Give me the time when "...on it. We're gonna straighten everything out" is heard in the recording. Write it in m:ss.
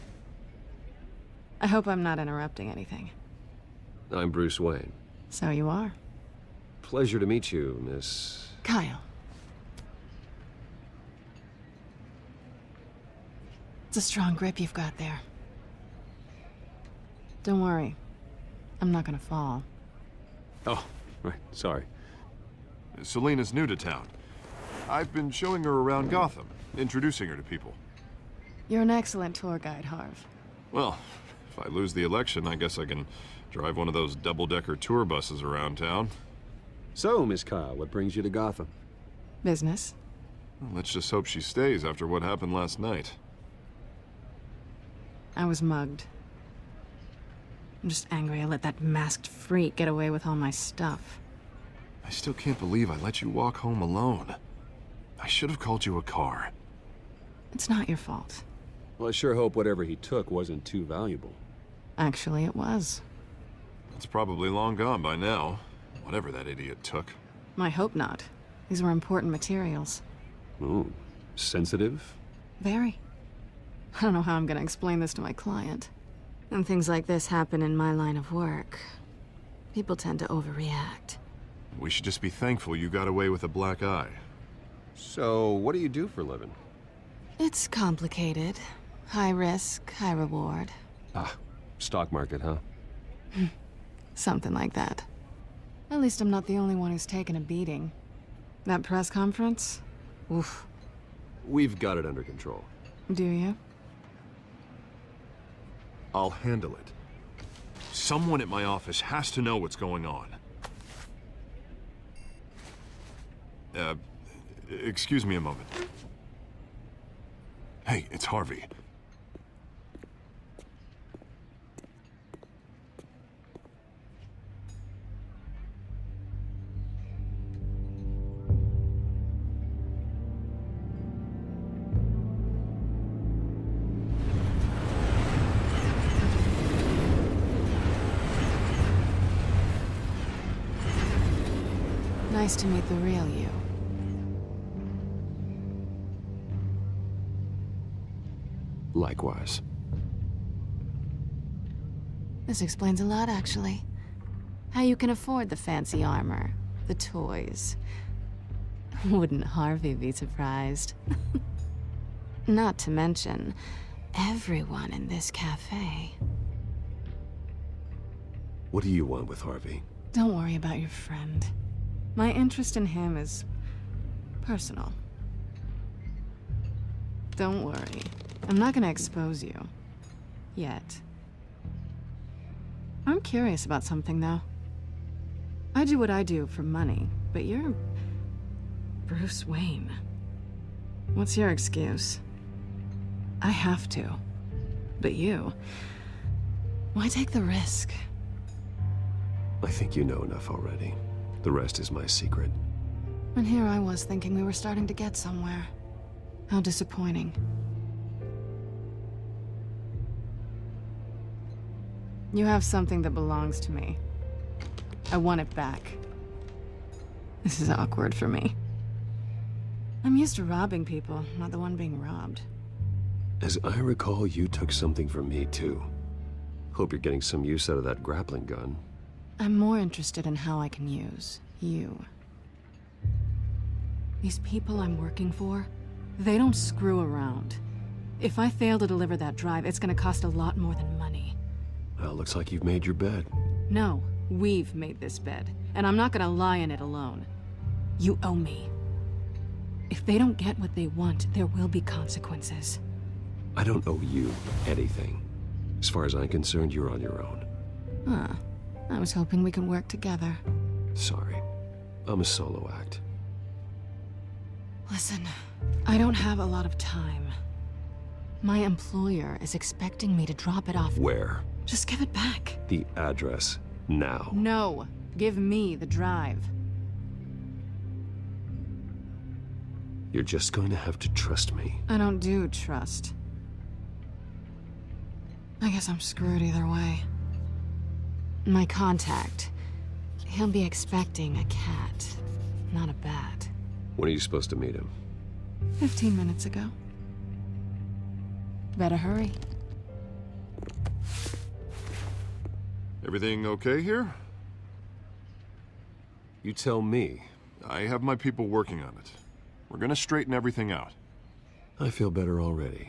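5:08.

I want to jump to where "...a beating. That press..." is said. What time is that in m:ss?
1:37.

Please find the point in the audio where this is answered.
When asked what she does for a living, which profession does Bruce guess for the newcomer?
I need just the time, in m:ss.
1:31.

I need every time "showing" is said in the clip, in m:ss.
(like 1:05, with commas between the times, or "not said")
0:25.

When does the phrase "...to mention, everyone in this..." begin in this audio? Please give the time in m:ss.
2:42.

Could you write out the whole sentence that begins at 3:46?
Hope you're getting some use out of that grappling gun.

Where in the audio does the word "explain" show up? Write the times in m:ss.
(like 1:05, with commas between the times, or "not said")
1:14, 2:32.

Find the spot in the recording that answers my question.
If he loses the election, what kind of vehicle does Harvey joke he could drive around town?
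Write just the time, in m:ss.
0:34.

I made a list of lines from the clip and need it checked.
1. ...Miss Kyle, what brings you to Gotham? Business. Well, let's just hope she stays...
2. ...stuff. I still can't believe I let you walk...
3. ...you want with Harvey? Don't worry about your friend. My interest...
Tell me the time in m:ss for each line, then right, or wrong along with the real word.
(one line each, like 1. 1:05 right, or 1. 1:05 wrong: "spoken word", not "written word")
1. 0:37 right
2. 0:50 right
3. 2:48 right.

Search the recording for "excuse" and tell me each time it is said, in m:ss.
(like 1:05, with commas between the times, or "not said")
1:54, 3:11.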